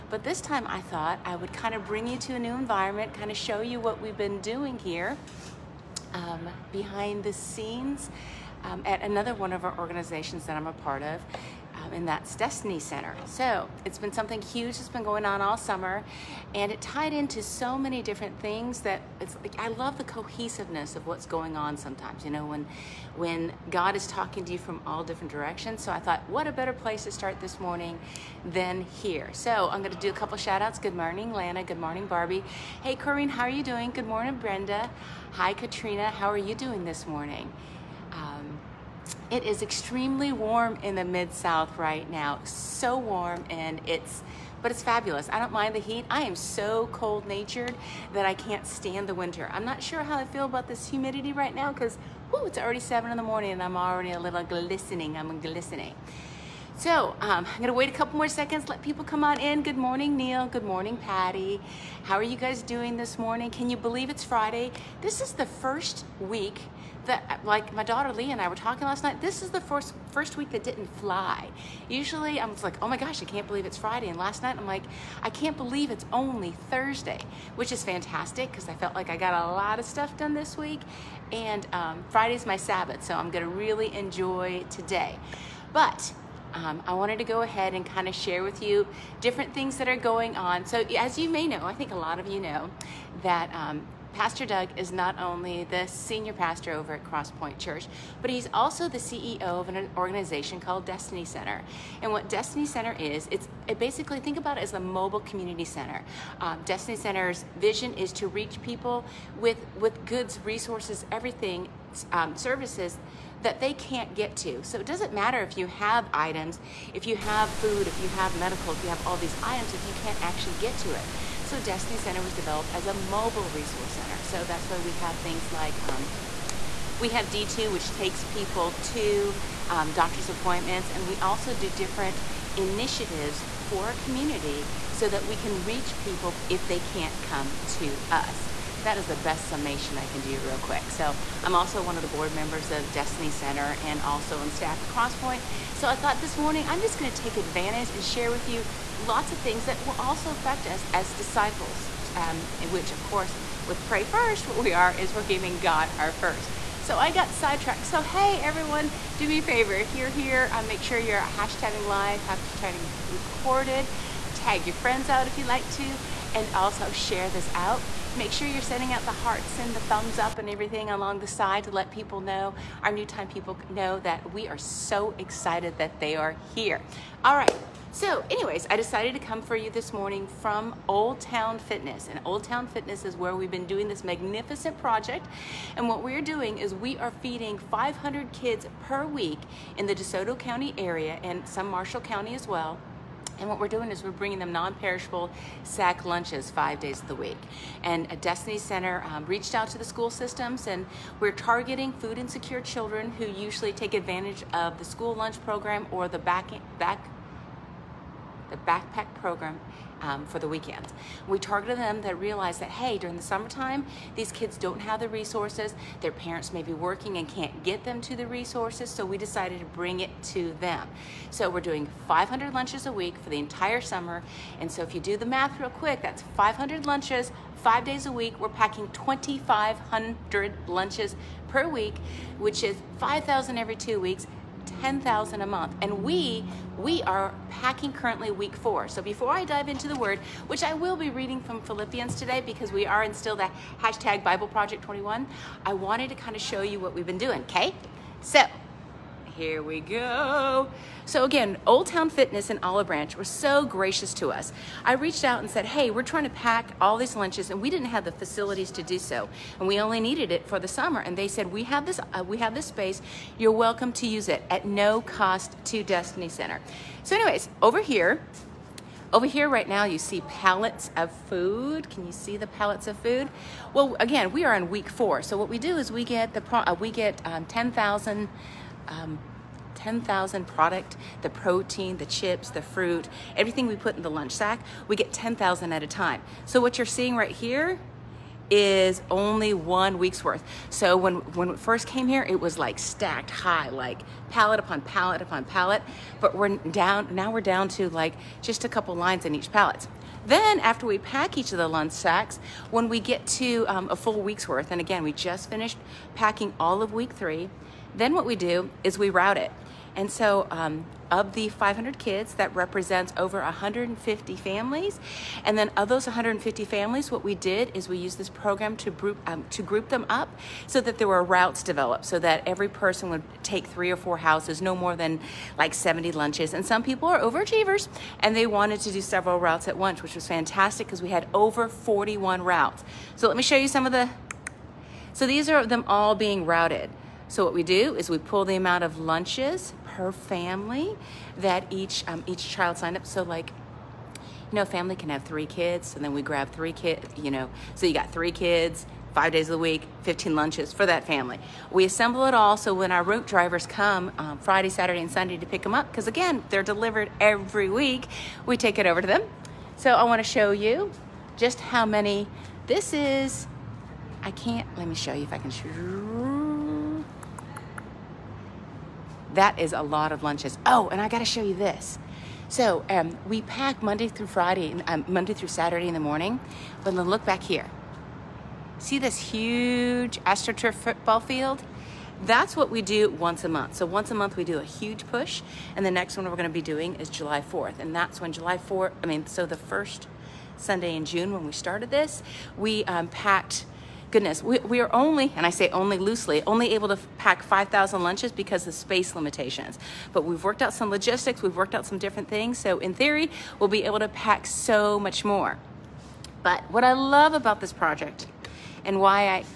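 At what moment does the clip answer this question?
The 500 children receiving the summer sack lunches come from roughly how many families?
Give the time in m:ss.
5:13.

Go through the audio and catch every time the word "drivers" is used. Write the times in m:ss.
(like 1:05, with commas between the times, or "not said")
5:53.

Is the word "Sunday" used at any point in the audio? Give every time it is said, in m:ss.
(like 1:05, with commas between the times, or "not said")
5:55, 6:30.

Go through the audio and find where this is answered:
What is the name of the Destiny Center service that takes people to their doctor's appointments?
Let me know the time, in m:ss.
2:07.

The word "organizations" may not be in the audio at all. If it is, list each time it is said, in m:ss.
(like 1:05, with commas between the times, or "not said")
0:09, 1:39.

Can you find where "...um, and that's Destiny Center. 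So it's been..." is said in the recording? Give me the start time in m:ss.
0:11.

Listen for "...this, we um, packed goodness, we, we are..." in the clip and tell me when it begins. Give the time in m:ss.
6:31.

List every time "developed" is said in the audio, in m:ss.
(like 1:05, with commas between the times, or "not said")
2:02, 5:21.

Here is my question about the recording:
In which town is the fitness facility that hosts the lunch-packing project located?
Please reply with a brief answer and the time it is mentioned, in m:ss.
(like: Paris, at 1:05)
Olive Branch, at 4:12.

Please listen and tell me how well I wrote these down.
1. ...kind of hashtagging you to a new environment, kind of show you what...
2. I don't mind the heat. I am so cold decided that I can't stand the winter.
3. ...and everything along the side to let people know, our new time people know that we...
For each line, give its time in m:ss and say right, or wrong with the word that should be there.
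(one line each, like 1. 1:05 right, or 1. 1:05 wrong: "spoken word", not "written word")
1. 0:01 wrong: "bring", not "hashtagging"
2. 0:45 wrong: "natured", not "decided"
3. 2:50 right.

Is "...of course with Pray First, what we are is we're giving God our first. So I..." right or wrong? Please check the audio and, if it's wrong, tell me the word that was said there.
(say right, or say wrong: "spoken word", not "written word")
right.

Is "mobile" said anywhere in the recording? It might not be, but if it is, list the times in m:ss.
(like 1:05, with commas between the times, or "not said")
1:44, 2:02.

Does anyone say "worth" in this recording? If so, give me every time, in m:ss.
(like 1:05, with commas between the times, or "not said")
4:50, 5:04.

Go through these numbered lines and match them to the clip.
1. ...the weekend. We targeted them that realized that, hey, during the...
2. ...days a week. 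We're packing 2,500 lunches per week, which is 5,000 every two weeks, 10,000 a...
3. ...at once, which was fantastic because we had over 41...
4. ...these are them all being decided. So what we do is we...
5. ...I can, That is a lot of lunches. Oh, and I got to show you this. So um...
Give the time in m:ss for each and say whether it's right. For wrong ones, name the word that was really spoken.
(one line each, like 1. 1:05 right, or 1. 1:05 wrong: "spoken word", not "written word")
1. 3:30 right
2. 3:47 right
3. 5:29 right
4. 5:35 wrong: "routed", not "decided"
5. 6:05 right.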